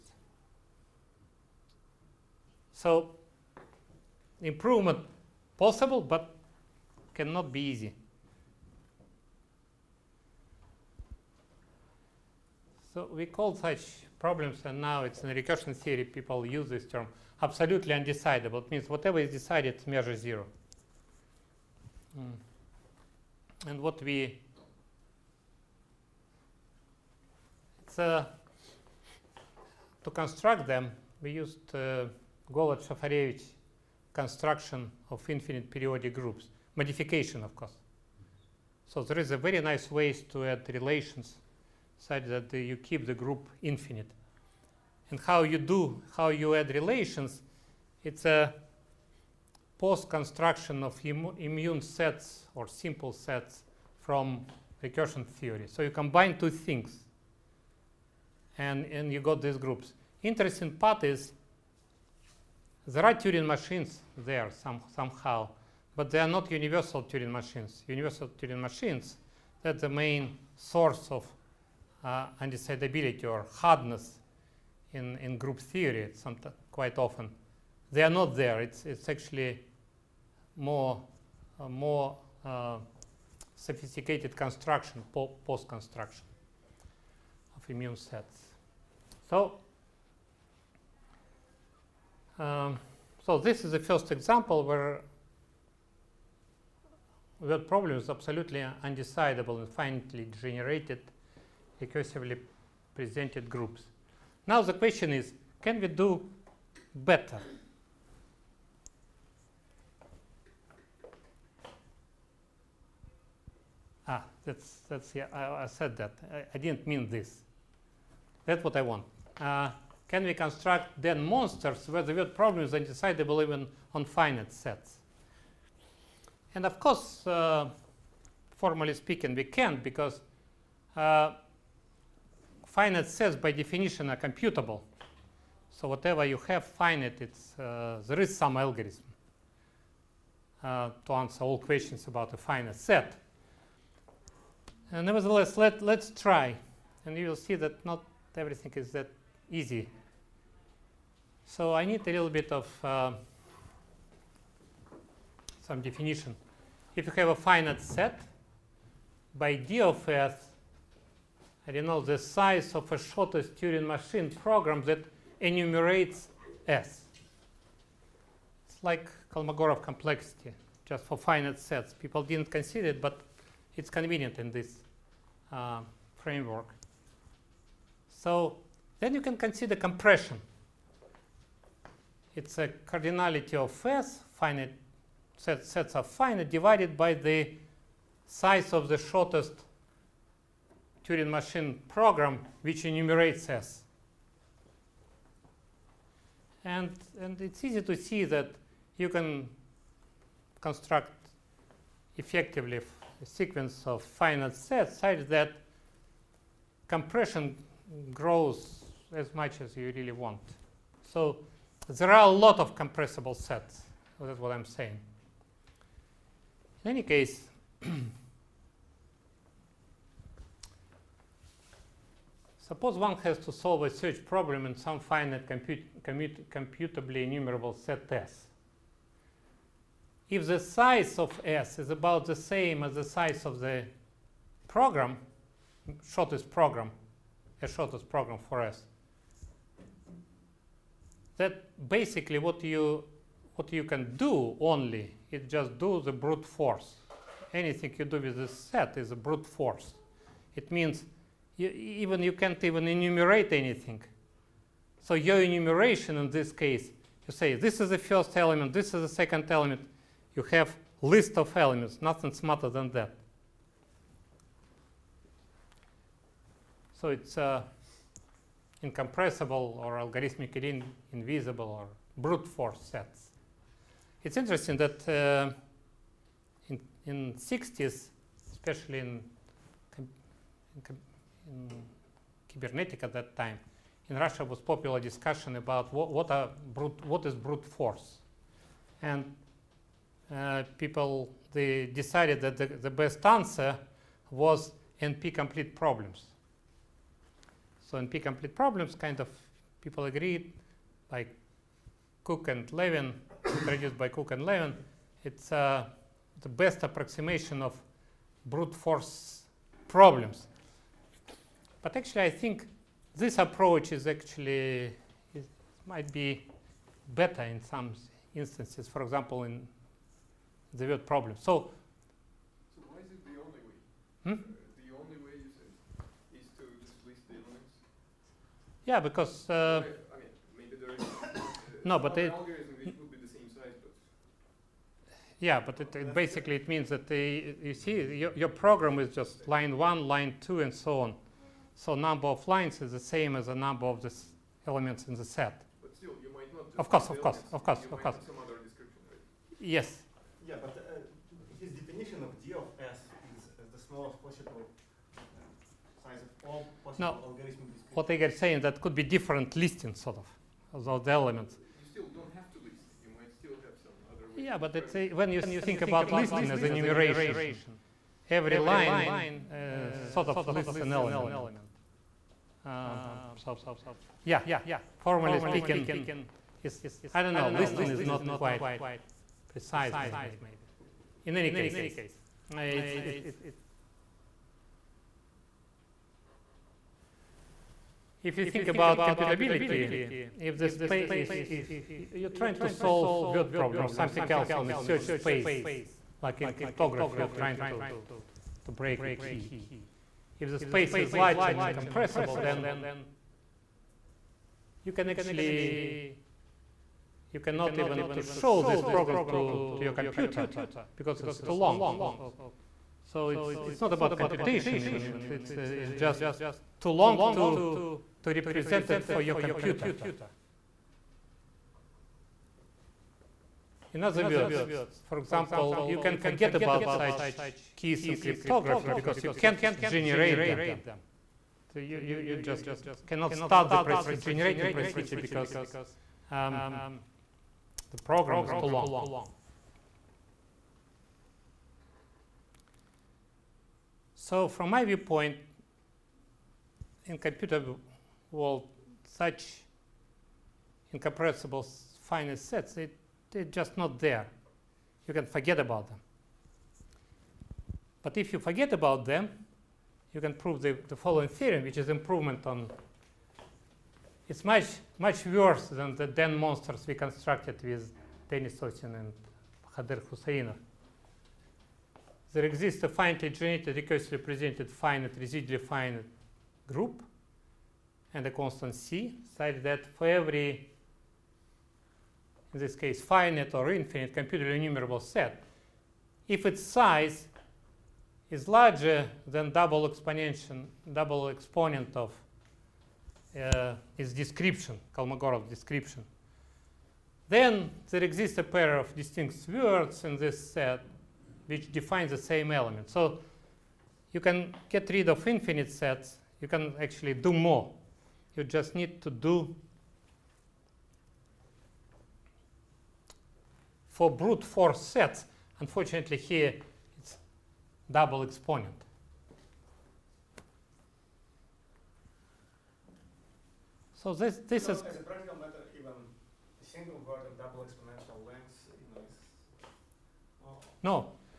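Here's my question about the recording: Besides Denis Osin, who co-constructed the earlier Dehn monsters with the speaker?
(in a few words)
Khader Khoussainov.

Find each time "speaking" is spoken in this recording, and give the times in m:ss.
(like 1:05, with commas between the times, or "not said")
2:08, 6:15.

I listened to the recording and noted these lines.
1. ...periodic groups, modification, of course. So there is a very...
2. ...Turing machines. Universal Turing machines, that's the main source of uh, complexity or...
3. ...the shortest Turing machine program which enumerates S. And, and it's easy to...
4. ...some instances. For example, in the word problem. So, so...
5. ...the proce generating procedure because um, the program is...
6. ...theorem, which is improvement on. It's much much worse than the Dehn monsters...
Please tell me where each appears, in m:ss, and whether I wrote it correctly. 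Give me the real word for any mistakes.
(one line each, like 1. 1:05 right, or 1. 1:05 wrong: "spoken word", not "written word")
1. 0:35 right
2. 1:07 wrong: "undecidability", not "complexity"
3. 3:08 right
4. 5:17 right
5. 7:13 right
6. 7:41 right.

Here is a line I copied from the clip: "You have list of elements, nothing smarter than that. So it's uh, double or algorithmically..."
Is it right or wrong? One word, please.
wrong.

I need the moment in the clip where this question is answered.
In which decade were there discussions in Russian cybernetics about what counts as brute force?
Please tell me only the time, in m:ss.
4:37.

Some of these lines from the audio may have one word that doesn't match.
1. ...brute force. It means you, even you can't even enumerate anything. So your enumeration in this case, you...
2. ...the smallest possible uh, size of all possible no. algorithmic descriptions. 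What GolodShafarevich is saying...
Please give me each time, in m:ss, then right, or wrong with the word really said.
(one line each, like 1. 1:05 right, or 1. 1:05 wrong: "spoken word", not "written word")
1. 4:09 right
2. 5:53 wrong: "Igor", not "GolodShafarevich".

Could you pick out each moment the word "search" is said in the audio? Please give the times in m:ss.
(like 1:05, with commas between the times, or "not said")
3:43, 6:34.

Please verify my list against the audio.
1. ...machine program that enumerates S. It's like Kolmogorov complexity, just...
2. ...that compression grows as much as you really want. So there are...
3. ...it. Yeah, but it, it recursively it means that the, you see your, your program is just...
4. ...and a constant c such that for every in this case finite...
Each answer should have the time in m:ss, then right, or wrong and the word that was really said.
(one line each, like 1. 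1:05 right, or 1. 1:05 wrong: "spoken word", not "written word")
1. 2:43 right
2. 3:25 right
3. 5:32 wrong: "basically", not "recursively"
4. 7:58 right.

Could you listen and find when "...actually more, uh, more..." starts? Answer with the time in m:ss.
1:19.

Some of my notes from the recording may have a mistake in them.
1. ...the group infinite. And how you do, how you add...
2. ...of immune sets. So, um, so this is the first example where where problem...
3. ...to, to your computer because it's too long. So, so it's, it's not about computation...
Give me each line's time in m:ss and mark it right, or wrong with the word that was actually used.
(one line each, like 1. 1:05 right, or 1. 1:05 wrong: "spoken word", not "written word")
1. 0:43 right
2. 1:27 right
3. 6:49 right.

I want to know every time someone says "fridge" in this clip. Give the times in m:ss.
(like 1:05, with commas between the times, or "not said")
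not said.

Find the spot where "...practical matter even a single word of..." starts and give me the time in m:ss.
8:45.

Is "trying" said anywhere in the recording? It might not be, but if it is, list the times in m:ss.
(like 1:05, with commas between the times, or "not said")
6:32, 6:37.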